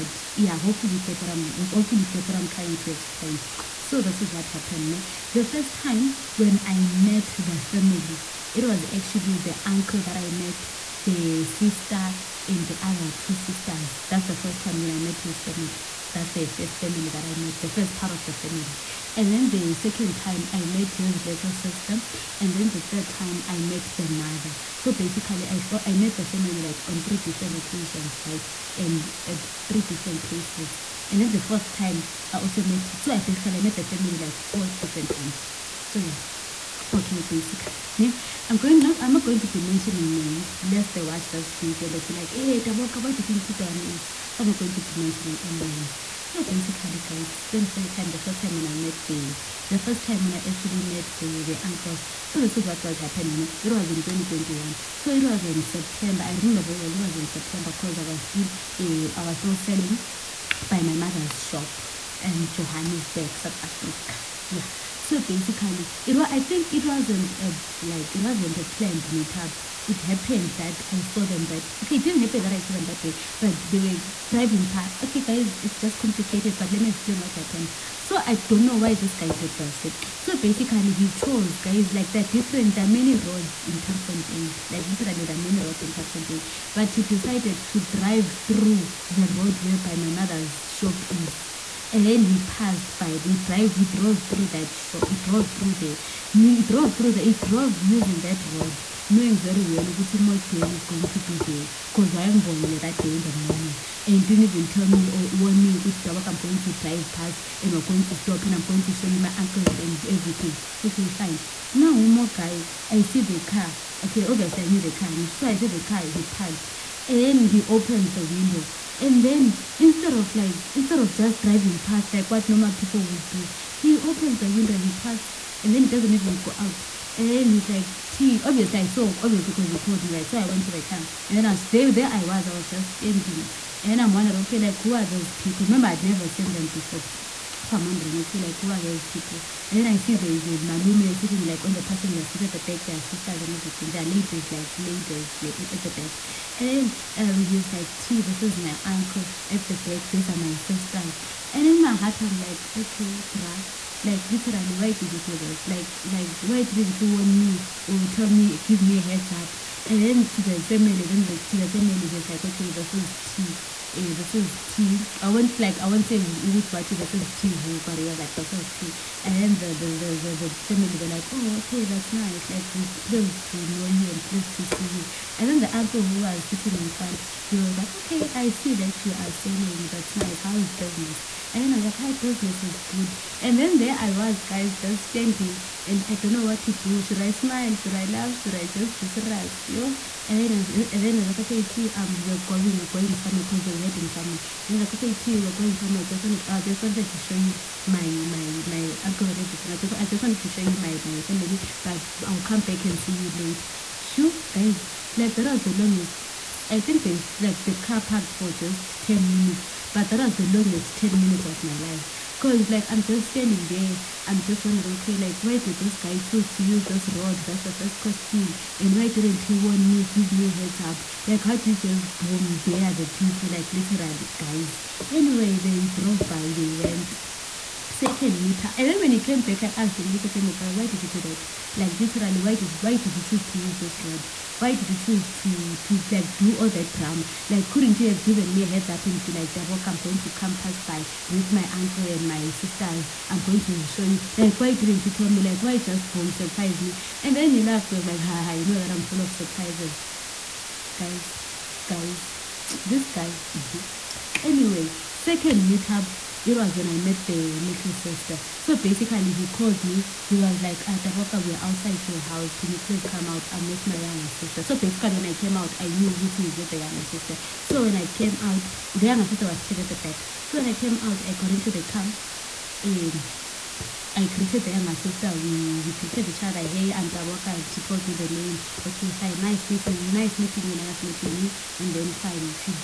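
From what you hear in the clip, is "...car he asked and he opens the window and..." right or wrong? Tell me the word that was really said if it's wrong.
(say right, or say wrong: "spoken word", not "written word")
wrong: "parked", not "asked".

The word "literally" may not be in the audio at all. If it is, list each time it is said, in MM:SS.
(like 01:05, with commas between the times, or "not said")
01:24, 02:34, 03:43, 03:51.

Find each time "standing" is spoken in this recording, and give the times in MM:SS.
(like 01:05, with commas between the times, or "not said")
02:12, 03:05, 03:33.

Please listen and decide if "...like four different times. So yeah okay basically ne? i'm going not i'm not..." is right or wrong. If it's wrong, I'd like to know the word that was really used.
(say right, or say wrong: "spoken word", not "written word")
right.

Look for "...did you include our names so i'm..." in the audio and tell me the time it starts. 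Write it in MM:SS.
00:43.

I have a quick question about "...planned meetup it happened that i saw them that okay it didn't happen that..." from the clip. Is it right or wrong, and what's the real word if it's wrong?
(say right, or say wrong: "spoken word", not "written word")
right.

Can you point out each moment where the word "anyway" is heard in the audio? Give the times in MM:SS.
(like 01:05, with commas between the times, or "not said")
03:45, 04:14.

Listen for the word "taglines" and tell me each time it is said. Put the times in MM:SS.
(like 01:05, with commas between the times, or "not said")
not said.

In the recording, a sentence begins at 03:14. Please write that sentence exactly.
And then like, okay, T, we're going somewhere.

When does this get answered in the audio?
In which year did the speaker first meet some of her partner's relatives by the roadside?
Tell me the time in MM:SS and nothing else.
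00:54.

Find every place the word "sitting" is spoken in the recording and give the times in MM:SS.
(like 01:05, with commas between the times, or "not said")
02:21, 02:56, 04:29.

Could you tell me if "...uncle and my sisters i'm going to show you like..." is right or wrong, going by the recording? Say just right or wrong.
right.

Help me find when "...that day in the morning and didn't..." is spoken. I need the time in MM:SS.
01:42.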